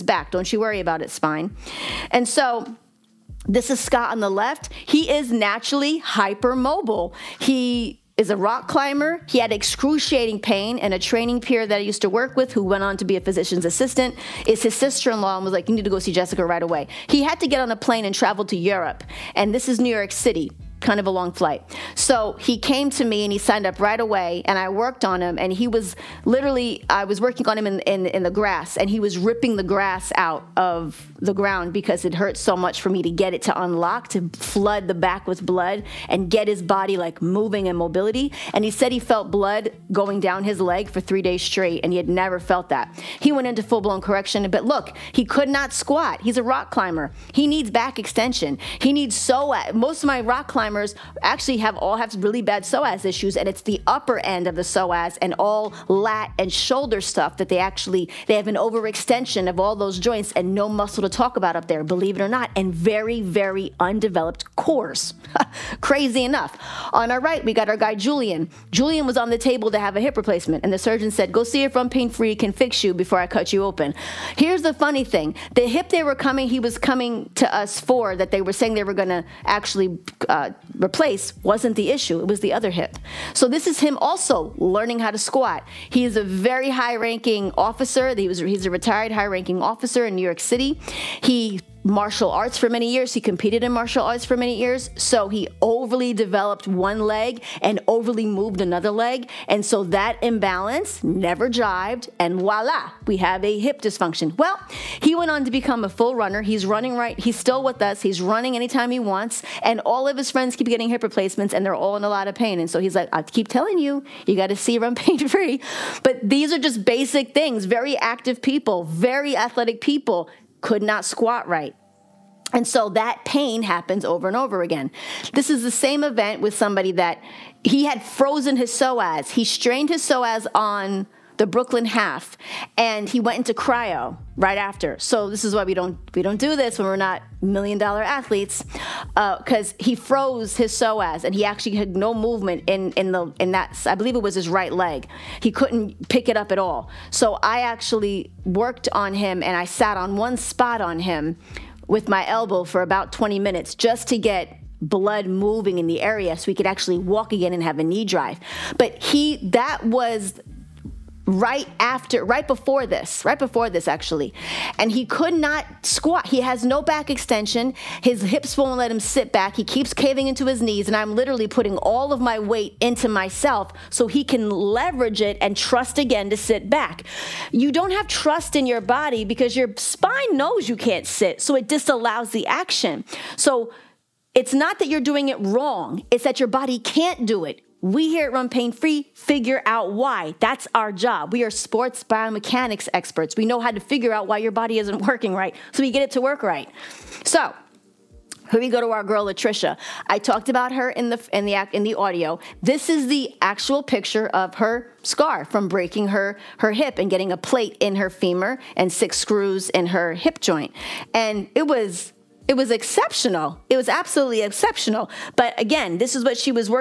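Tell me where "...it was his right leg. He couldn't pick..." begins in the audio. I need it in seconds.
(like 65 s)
144 s.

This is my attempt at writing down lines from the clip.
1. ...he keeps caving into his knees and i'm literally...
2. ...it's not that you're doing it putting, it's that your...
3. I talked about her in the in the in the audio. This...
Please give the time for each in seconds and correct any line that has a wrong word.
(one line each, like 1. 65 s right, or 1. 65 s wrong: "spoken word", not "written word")
1. 169 s right
2. 184 s wrong: "wrong", not "putting"
3. 200 s right.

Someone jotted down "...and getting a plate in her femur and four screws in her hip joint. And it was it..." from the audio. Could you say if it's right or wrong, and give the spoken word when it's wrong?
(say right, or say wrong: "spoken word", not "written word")
wrong: "six", not "four".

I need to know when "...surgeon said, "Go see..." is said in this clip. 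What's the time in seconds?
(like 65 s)
70 s.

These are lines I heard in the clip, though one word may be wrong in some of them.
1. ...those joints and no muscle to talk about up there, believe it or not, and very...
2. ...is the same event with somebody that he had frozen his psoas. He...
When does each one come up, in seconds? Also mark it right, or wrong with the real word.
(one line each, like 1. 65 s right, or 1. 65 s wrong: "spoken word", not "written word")
1. 59 s right
2. 125 s right.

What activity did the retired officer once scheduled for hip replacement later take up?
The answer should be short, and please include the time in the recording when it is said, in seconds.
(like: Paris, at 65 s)
Full runner, at 105 s.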